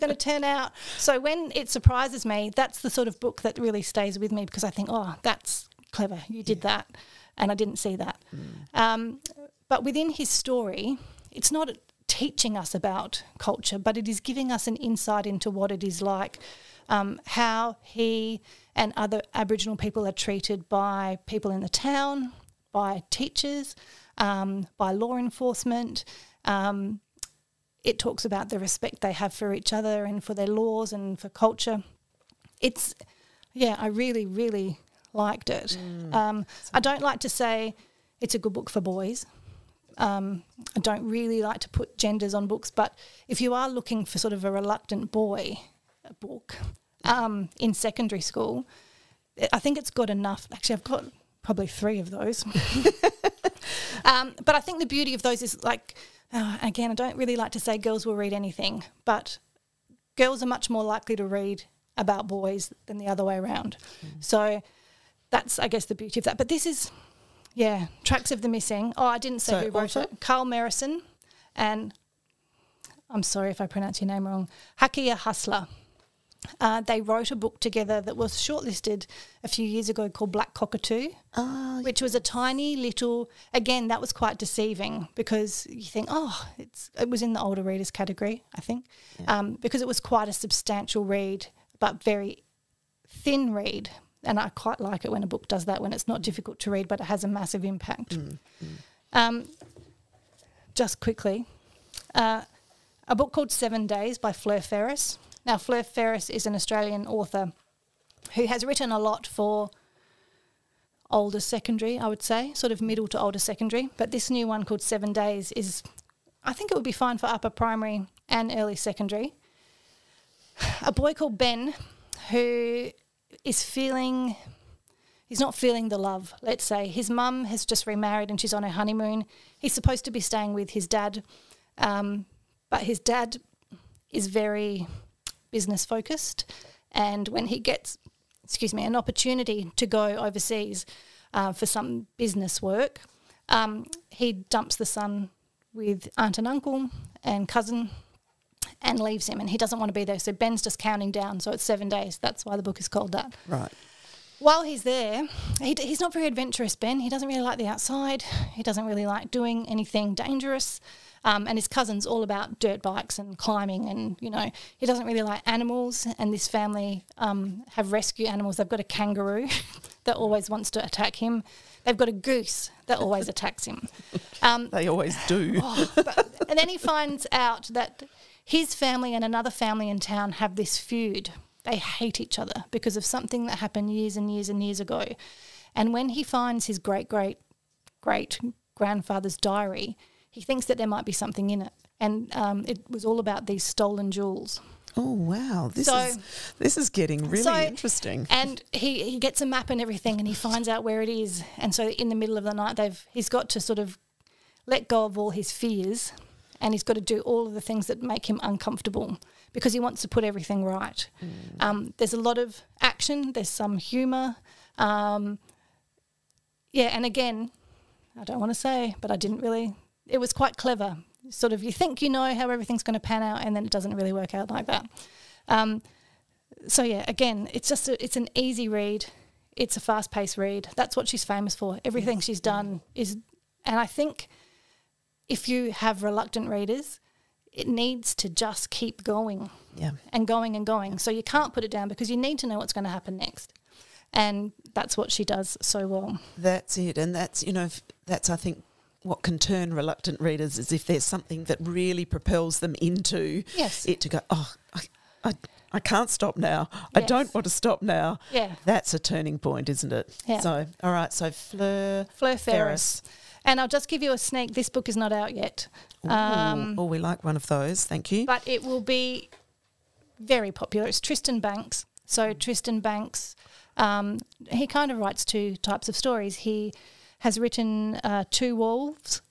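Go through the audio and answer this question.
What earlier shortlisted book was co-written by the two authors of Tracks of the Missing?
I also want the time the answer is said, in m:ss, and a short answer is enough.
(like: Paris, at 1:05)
Black Cockatoo, at 1:20.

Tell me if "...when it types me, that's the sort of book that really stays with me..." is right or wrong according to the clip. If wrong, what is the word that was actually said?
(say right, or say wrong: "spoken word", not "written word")
wrong: "surprises", not "types".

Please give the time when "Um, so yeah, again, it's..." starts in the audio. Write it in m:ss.
3:45.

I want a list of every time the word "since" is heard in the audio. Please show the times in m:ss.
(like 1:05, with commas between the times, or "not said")
not said.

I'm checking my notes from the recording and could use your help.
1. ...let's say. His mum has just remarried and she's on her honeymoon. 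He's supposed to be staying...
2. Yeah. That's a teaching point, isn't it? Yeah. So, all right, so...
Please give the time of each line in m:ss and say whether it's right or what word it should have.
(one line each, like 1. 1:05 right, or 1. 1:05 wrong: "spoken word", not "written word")
1. 2:06 right
2. 4:18 wrong: "turning", not "teaching".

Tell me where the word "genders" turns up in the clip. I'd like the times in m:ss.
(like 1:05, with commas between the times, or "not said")
0:41.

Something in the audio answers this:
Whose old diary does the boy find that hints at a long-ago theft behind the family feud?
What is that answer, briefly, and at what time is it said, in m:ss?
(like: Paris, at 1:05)
His great great great grandfather's, at 3:06.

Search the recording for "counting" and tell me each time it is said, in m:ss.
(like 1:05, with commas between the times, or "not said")
2:30.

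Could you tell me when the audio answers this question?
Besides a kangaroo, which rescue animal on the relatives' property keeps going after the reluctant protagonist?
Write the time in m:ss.
2:52.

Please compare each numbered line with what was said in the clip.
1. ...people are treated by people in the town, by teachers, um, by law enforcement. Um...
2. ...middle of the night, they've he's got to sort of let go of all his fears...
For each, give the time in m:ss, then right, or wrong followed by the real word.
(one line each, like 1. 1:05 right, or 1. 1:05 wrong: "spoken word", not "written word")
1. 0:19 right
2. 3:22 right.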